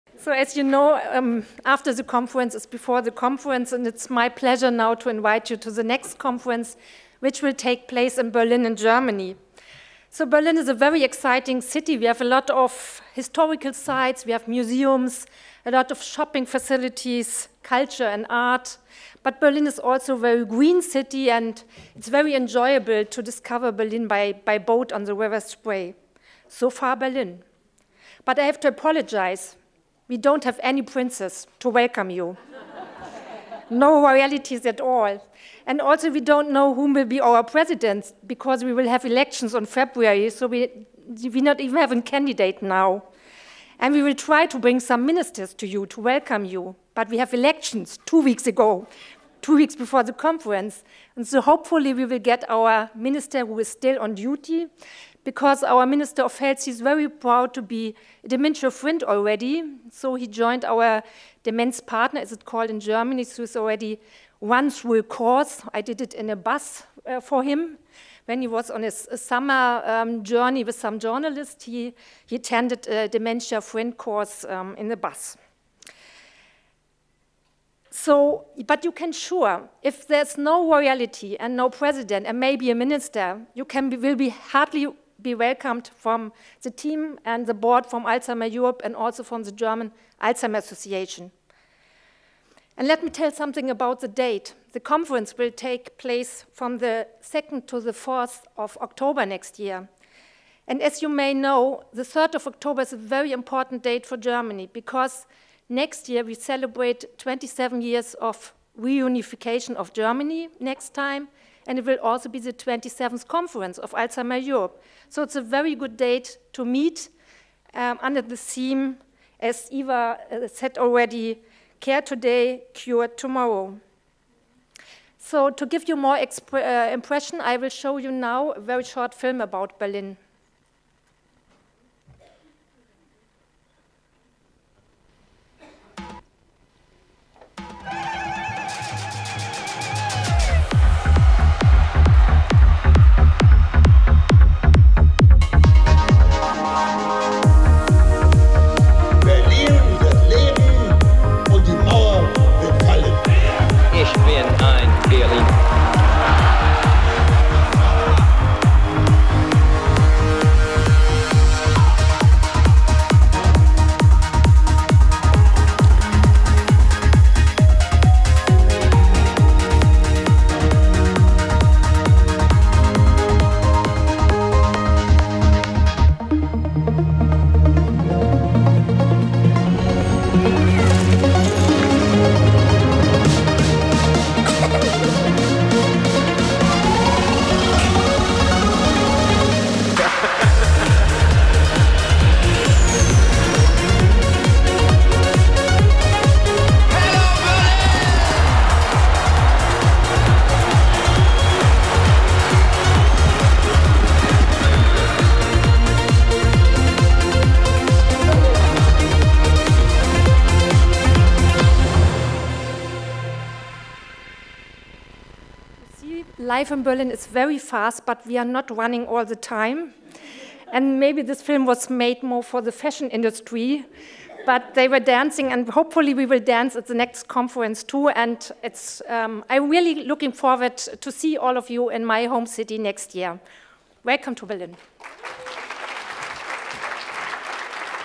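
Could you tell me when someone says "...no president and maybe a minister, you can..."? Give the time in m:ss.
1:21.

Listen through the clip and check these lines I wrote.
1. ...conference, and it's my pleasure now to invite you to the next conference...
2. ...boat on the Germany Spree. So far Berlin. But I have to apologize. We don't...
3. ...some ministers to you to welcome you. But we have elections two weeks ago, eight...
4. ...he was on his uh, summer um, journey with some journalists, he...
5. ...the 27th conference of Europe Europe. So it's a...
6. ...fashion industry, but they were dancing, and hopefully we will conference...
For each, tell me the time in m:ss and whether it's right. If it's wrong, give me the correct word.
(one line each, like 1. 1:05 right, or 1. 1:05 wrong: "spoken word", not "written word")
1. 0:03 right
2. 0:24 wrong: "River", not "Germany"
3. 0:44 wrong: "two", not "eight"
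4. 1:08 right
5. 1:52 wrong: "Alzheimer", not "Europe"
6. 3:42 wrong: "dance", not "conference".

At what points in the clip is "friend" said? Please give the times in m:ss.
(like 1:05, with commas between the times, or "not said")
0:58, 1:13.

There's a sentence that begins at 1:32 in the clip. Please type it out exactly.
And let me tell something about the date.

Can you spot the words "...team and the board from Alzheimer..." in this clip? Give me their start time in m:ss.
1:26.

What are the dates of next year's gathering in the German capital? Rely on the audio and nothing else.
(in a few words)
2nd to 4th October.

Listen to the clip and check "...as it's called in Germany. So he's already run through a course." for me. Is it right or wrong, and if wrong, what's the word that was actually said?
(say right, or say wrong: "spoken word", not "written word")
right.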